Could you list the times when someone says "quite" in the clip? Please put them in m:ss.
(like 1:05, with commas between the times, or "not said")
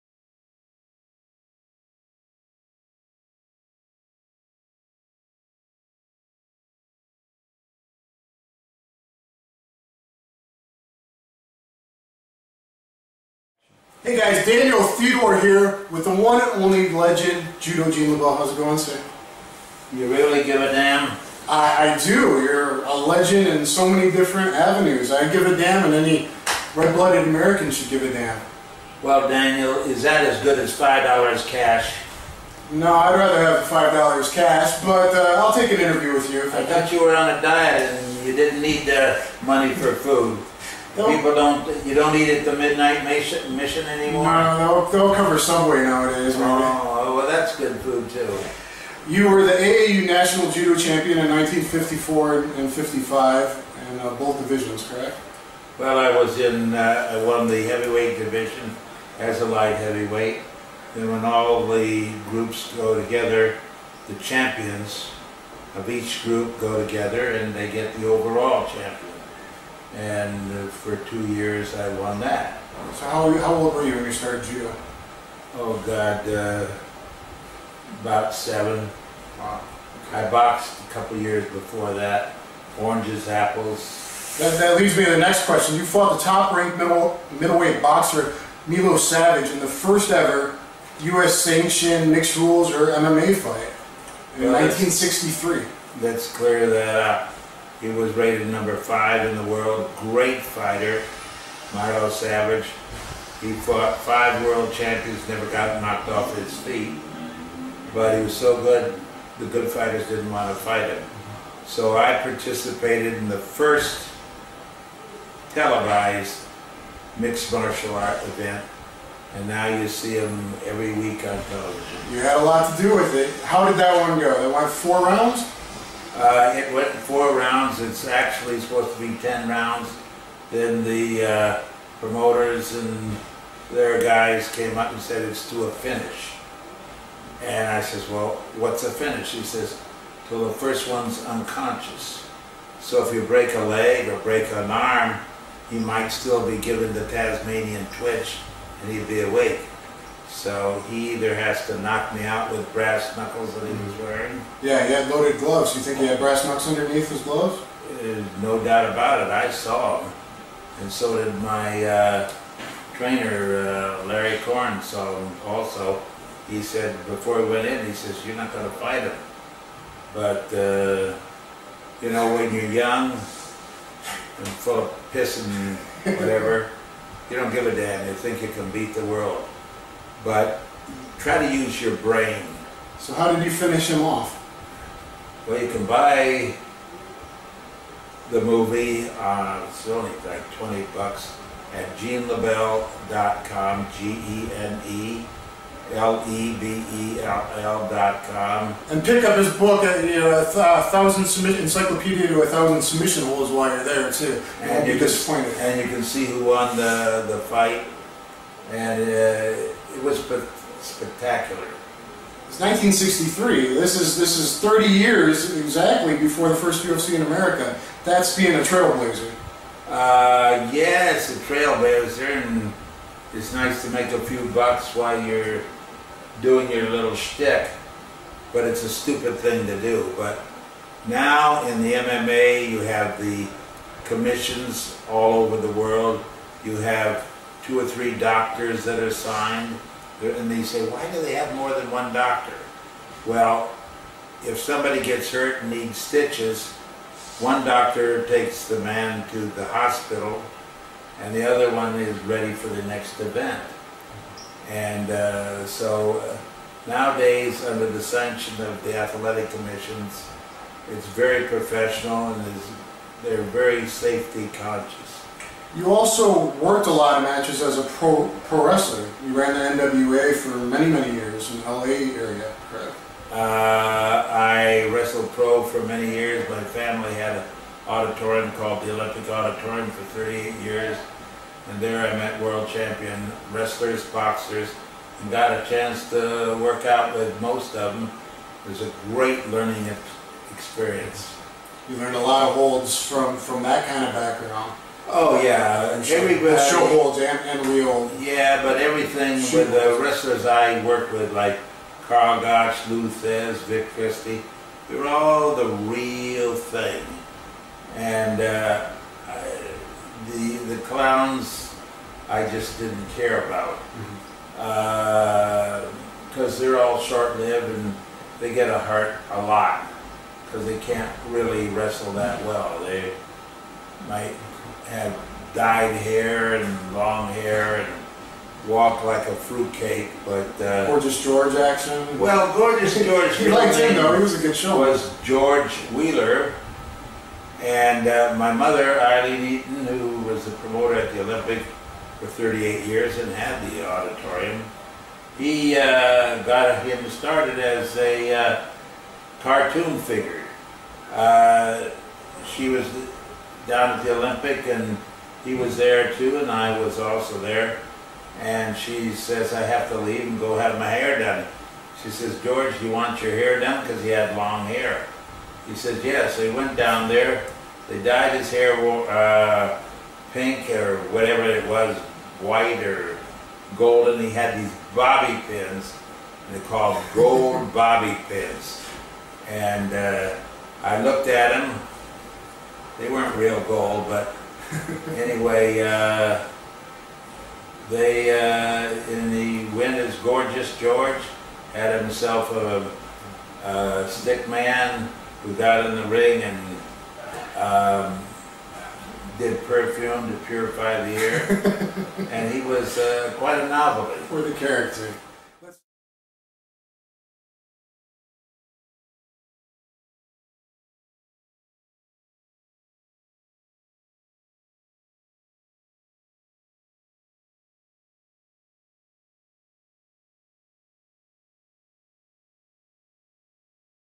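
6:43.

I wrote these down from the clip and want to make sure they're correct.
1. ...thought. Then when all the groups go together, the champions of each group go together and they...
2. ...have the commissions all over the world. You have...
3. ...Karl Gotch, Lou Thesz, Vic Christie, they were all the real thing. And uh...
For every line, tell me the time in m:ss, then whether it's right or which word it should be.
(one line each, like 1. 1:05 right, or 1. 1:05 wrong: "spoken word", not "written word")
1. 0:59 wrong: "heavyweight", not "thought"
2. 3:52 right
3. 5:02 right.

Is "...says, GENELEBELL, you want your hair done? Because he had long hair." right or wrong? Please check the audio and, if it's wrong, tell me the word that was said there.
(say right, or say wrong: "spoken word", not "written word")
wrong: "George", not "GENELEBELL".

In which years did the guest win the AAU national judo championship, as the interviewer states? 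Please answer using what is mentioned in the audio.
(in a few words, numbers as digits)
1954 and 55.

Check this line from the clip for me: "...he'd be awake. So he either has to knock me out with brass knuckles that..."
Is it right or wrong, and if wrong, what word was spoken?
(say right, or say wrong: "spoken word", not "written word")
right.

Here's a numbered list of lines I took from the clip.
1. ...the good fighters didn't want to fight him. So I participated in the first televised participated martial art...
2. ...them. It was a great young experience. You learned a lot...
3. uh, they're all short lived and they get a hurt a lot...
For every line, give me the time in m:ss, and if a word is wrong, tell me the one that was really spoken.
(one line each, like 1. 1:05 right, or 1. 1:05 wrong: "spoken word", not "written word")
1. 1:49 wrong: "mixed", not "participated"
2. 4:47 wrong: "learning", not "young"
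3. 5:16 right.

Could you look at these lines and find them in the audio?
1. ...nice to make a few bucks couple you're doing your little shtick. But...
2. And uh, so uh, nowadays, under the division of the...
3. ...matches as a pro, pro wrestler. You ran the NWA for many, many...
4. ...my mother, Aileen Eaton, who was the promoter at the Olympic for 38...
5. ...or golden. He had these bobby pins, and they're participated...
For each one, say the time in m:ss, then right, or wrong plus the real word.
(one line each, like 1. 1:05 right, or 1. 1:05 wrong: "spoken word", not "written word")
1. 3:43 wrong: "while", not "couple"
2. 4:14 wrong: "sanction", not "division"
3. 4:27 right
4. 5:38 right
5. 6:12 wrong: "called", not "participated".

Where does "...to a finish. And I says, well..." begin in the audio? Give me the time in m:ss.
2:15.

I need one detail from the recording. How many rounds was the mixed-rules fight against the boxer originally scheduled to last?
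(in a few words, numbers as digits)
10.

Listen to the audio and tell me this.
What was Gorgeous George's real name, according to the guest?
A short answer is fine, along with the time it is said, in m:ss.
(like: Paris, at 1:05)
George Wheeler, at 5:35.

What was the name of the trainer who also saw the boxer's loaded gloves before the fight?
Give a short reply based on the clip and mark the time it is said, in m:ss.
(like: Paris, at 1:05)
Larry Korn, at 2:44.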